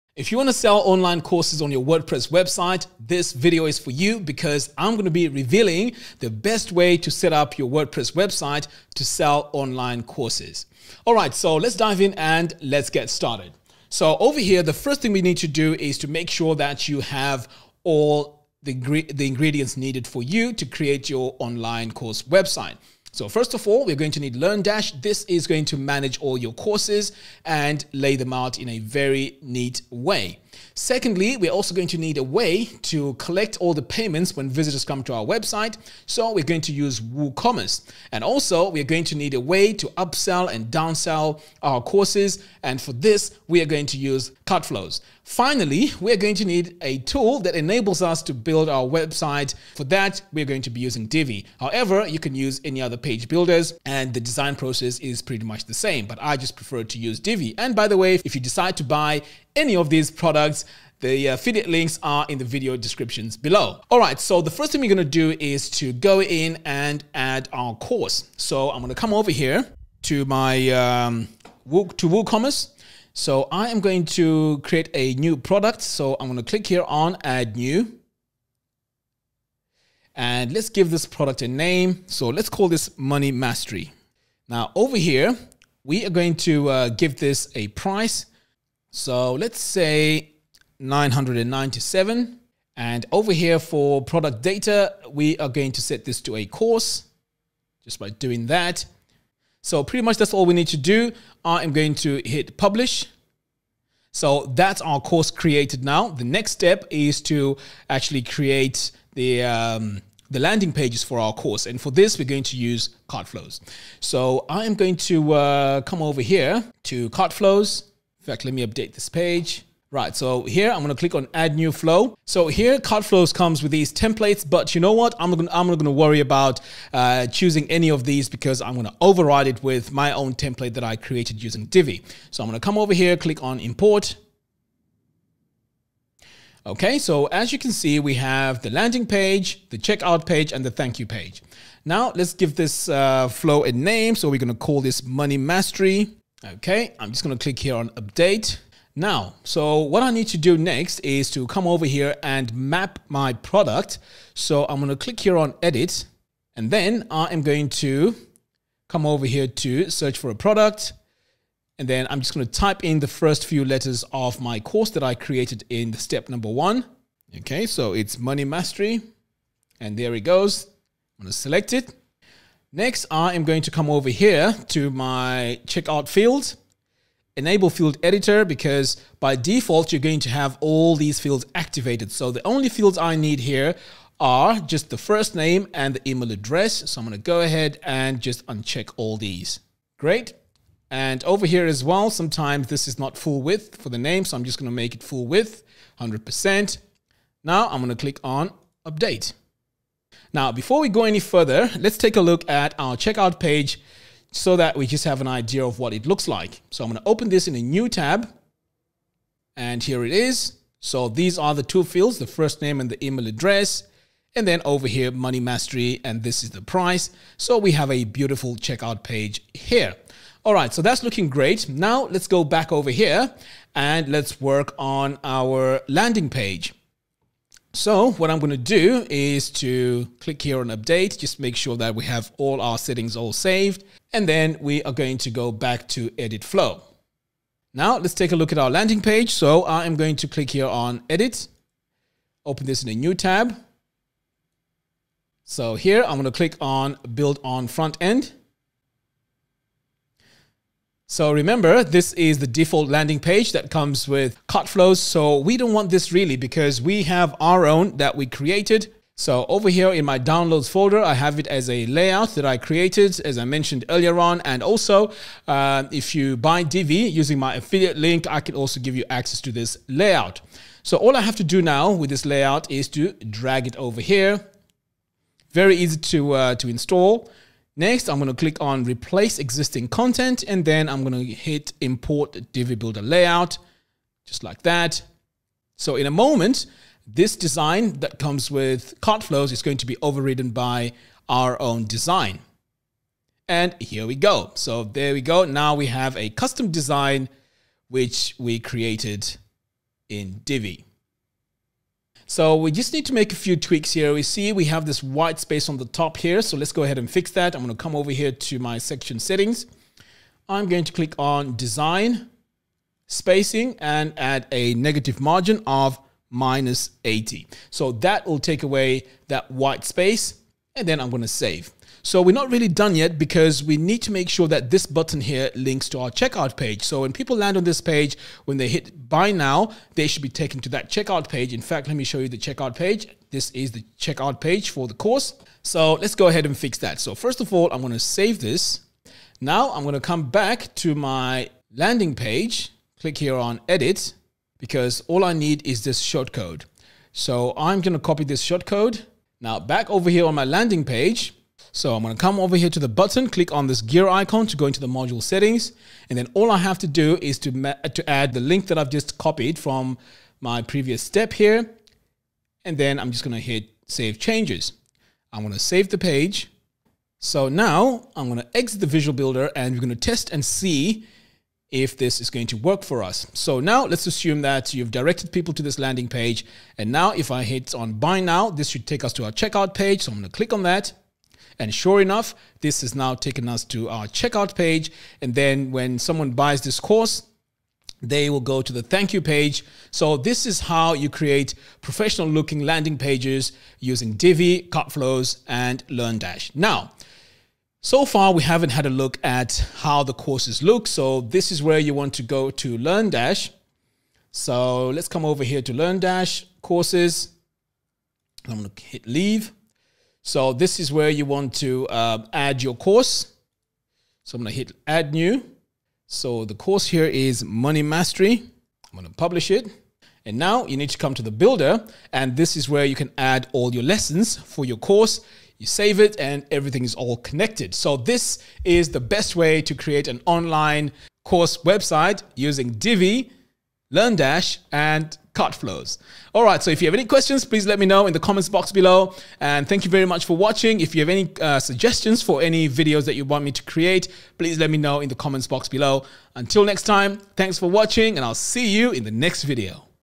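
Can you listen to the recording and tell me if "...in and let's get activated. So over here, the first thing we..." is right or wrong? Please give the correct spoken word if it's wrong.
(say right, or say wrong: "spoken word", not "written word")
wrong: "started", not "activated".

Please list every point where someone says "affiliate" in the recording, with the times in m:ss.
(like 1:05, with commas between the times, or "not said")
1:01, 4:27.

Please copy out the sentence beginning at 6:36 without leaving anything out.
Now, so far we haven't had a look at how the courses look.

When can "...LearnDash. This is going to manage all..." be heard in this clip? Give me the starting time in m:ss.
0:24.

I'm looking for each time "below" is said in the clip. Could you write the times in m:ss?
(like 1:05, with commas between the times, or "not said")
1:03, 7:18, 7:25.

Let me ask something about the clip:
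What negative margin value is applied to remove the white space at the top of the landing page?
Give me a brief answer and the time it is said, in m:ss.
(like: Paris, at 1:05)
-80, at 5:16.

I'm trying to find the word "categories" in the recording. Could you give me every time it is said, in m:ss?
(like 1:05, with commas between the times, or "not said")
not said.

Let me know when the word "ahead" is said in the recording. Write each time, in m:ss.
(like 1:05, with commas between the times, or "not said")
3:07, 5:06, 5:36.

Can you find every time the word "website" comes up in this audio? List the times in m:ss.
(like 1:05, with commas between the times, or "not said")
0:02, 0:08, 0:22, 0:35, 0:48, 7:11.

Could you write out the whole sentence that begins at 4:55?
Now we have a custom design which we created in Divi.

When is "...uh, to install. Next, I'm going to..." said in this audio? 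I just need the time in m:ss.
4:36.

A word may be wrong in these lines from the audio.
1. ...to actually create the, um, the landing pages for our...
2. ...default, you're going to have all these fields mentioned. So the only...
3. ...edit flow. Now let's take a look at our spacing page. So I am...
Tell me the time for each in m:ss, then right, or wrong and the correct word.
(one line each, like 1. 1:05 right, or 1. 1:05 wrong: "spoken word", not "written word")
1. 1:47 right
2. 2:59 wrong: "activated", not "mentioned"
3. 3:56 wrong: "landing", not "spacing".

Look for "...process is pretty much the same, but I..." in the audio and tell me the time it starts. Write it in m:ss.
0:54.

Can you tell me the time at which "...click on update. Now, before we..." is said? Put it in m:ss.
3:17.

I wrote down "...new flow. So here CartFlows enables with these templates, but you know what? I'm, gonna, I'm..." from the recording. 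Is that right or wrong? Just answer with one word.
wrong.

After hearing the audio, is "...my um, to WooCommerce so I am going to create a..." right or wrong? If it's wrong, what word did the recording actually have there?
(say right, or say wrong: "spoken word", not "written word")
right.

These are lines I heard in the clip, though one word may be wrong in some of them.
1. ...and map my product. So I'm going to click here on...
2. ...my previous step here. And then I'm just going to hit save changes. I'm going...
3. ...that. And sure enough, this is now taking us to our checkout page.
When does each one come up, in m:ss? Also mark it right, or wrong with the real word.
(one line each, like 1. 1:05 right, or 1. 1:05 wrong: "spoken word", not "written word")
1. 2:32 right
2. 6:00 right
3. 6:20 right.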